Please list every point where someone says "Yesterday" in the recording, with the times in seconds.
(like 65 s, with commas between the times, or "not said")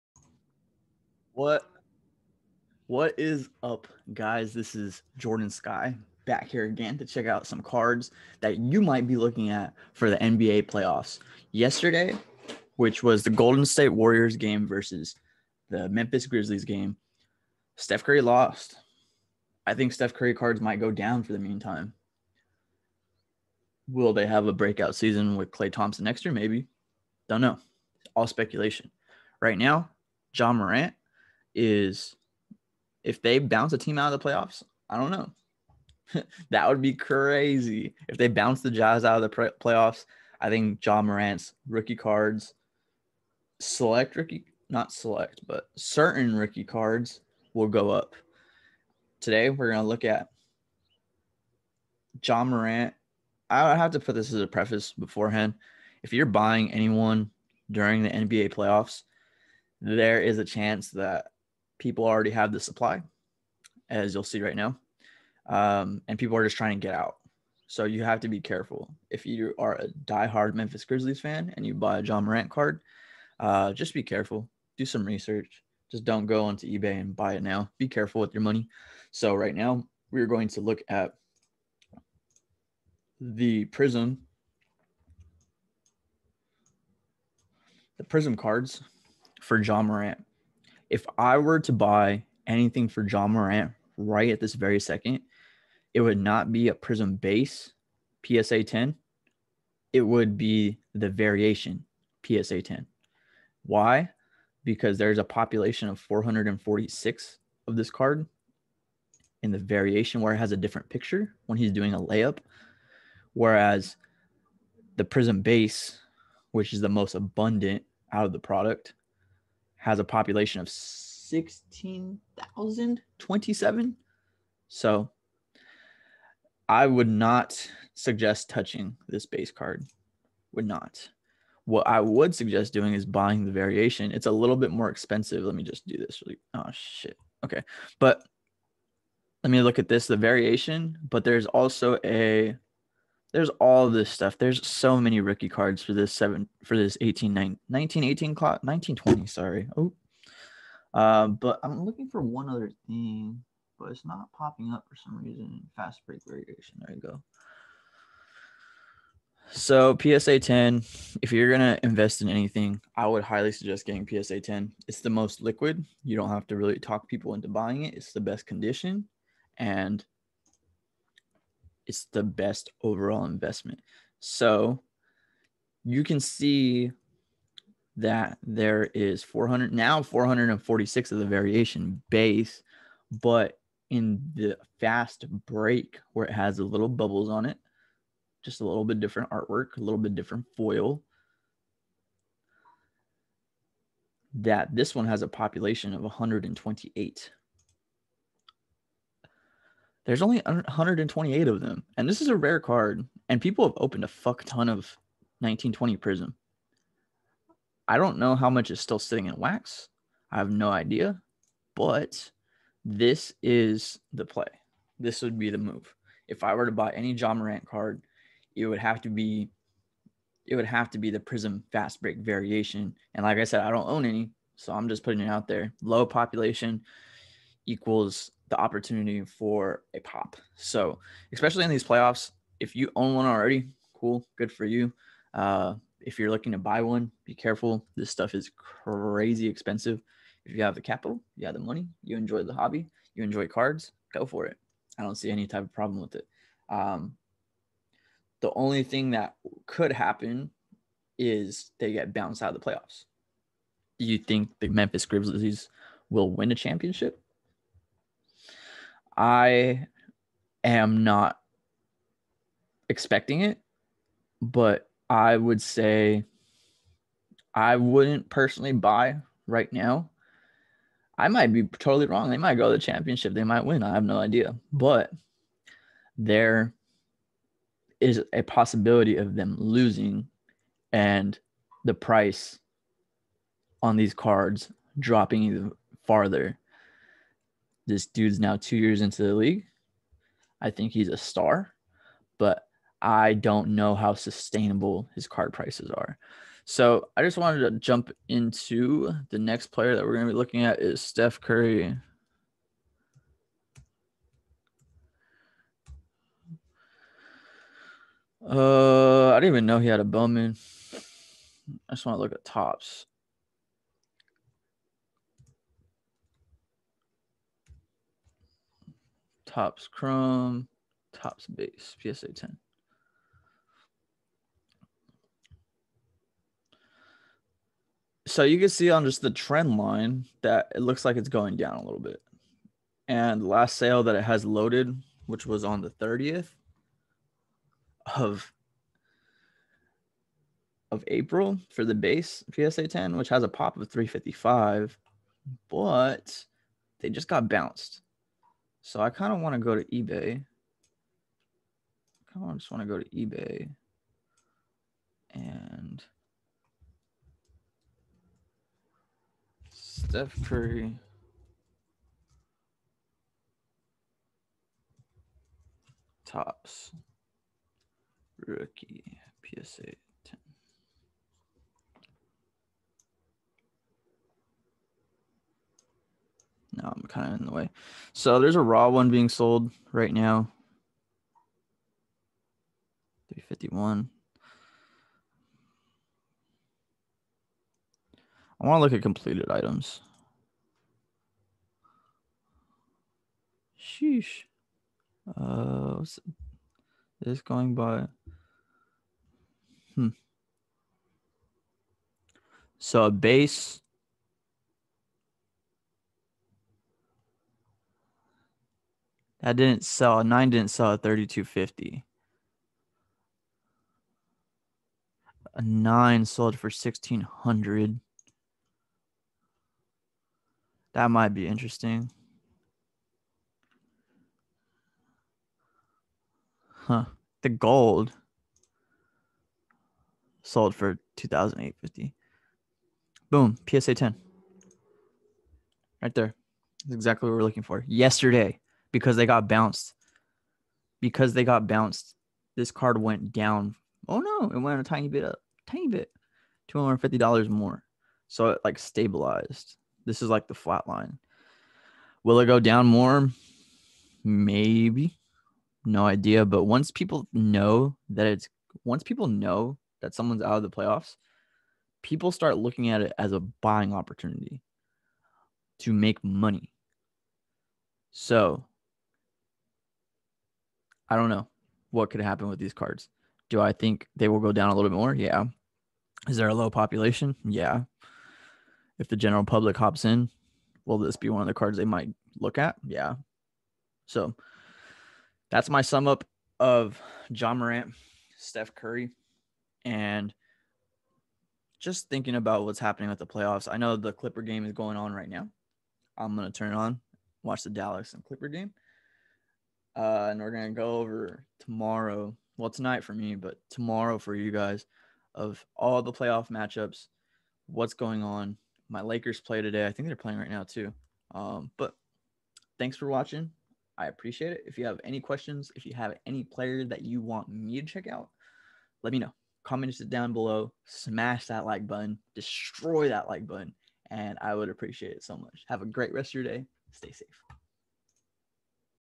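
11 s, 437 s.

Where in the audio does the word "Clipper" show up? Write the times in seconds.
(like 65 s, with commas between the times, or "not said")
494 s, 498 s.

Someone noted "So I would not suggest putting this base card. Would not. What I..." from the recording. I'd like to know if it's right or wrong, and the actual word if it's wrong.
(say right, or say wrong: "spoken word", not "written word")
wrong: "touching", not "putting".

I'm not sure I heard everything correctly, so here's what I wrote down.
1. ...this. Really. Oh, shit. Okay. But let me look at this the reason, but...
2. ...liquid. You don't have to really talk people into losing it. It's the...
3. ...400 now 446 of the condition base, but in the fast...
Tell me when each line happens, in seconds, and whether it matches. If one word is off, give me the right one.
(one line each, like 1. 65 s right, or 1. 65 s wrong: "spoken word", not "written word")
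1. 135 s wrong: "variation", not "reason"
2. 165 s wrong: "buying", not "losing"
3. 179 s wrong: "variation", not "condition".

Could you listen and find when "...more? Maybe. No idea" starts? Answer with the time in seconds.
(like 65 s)
452 s.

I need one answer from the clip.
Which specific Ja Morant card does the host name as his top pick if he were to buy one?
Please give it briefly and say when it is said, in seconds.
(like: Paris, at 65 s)
Prism fast break variation, at 221 s.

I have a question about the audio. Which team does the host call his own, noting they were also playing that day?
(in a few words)
Lakers.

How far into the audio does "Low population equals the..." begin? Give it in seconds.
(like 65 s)
225 s.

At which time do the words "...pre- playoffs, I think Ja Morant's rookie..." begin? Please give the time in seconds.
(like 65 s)
39 s.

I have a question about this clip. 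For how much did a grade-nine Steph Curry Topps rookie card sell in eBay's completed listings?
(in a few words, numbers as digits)
1600.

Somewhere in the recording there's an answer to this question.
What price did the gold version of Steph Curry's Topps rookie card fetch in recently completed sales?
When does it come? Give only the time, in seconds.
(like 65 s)
431 s.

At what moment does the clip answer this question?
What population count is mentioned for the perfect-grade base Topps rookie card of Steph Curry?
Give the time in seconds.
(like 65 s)
343 s.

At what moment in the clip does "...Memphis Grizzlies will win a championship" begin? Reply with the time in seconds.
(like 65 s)
254 s.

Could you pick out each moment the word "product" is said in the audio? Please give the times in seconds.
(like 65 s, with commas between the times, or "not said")
118 s.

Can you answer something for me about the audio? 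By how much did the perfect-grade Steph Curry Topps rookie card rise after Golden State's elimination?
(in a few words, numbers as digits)
$250.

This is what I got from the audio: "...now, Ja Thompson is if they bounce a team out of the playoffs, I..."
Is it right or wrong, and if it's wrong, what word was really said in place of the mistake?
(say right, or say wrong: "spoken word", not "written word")
wrong: "Morant", not "Thompson".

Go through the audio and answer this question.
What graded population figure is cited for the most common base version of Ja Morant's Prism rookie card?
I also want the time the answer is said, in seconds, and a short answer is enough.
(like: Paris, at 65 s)
16,027, at 120 s.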